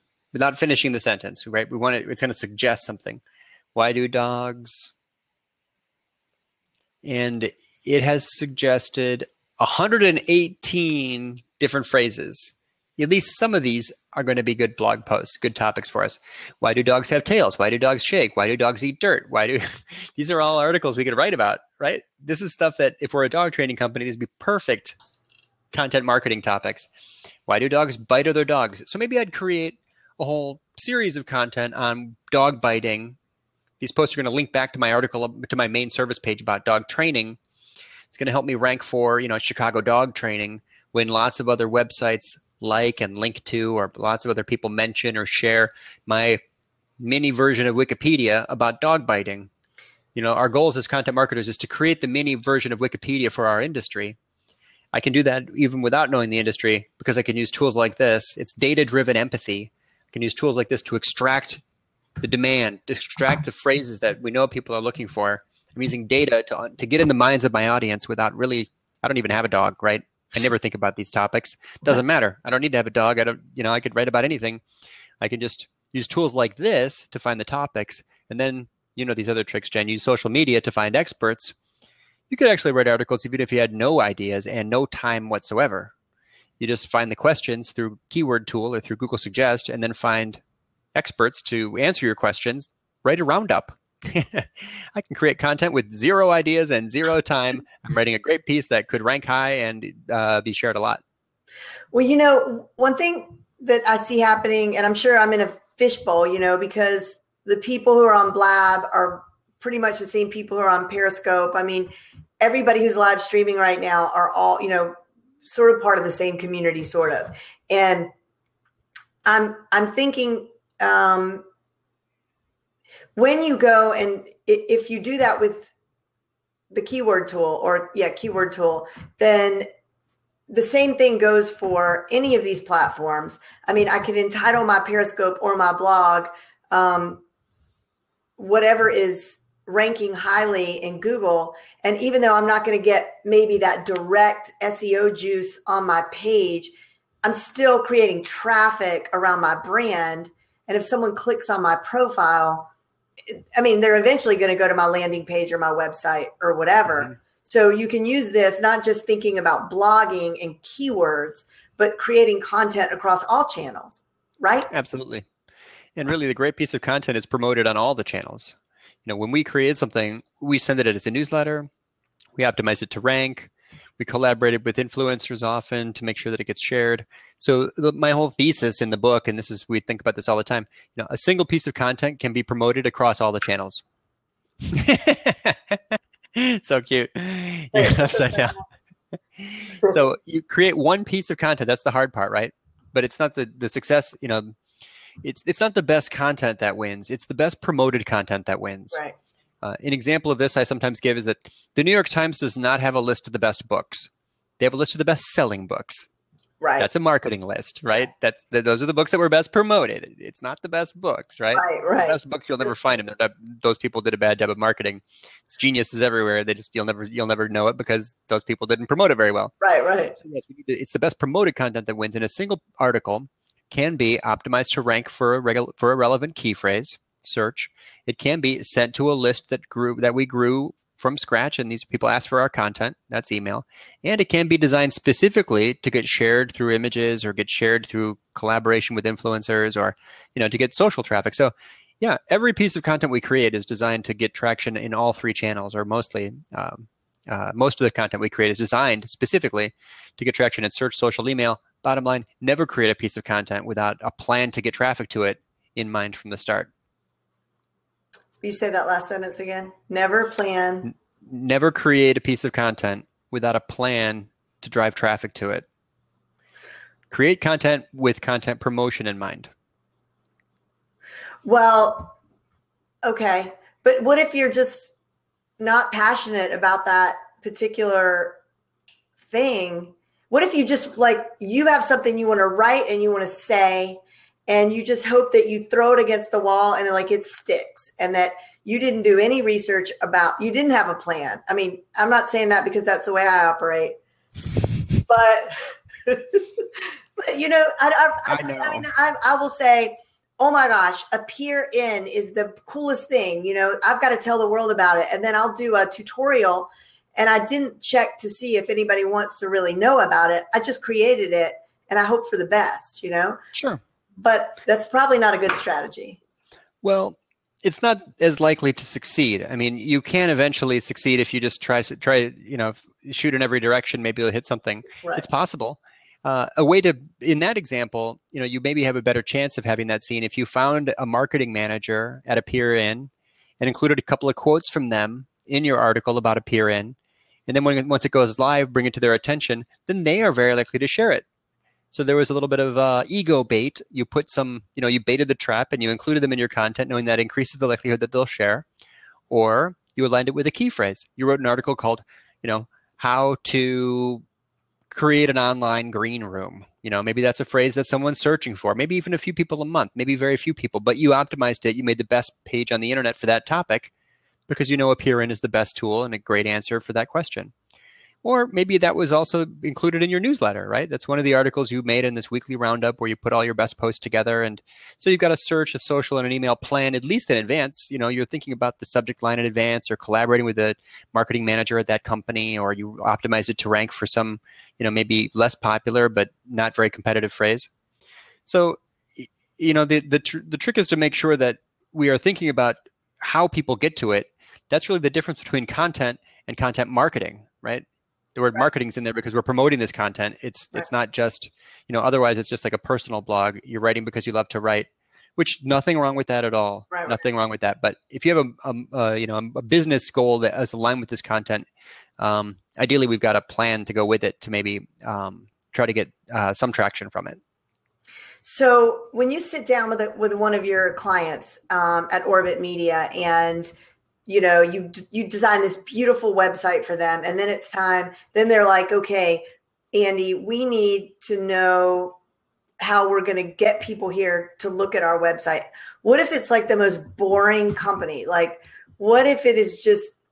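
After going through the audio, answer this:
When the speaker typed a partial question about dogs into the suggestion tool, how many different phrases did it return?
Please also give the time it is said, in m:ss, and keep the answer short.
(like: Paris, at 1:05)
118, at 0:09.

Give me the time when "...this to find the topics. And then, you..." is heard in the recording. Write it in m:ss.
1:16.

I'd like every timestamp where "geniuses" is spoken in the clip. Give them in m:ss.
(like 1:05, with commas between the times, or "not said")
3:35.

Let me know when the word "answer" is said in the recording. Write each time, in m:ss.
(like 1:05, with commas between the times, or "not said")
1:31, 6:06.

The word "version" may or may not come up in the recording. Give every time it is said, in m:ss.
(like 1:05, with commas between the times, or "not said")
0:47, 0:52.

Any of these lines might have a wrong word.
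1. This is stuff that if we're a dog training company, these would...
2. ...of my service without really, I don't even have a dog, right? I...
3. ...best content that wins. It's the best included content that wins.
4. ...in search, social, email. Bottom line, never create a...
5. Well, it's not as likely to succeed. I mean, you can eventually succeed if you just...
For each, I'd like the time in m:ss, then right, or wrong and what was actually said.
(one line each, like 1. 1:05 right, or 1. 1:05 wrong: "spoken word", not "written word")
1. 0:22 right
2. 1:07 wrong: "audience", not "service"
3. 3:15 wrong: "promoted", not "included"
4. 4:10 right
5. 5:16 right.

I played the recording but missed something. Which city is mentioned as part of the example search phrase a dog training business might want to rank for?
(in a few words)
Chicago.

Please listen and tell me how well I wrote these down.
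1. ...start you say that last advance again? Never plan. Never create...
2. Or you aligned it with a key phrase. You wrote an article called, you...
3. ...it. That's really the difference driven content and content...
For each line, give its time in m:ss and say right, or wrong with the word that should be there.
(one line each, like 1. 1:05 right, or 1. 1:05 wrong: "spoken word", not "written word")
1. 4:16 wrong: "sentence", not "advance"
2. 5:49 right
3. 6:34 wrong: "between", not "driven".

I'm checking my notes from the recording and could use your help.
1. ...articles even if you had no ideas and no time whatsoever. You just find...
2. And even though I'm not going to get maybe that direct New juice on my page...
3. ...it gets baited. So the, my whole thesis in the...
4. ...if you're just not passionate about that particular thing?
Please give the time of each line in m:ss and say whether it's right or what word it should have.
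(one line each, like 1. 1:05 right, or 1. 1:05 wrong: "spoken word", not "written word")
1. 1:22 right
2. 2:21 wrong: "SEO", not "New"
3. 2:56 wrong: "shared", not "baited"
4. 4:34 right.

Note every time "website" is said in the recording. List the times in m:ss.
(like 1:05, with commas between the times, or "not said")
0:41, 2:35, 7:06, 7:15.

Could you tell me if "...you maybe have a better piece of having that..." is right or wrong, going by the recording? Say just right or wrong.
wrong.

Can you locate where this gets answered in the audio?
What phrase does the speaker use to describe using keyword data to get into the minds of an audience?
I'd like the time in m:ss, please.
0:58.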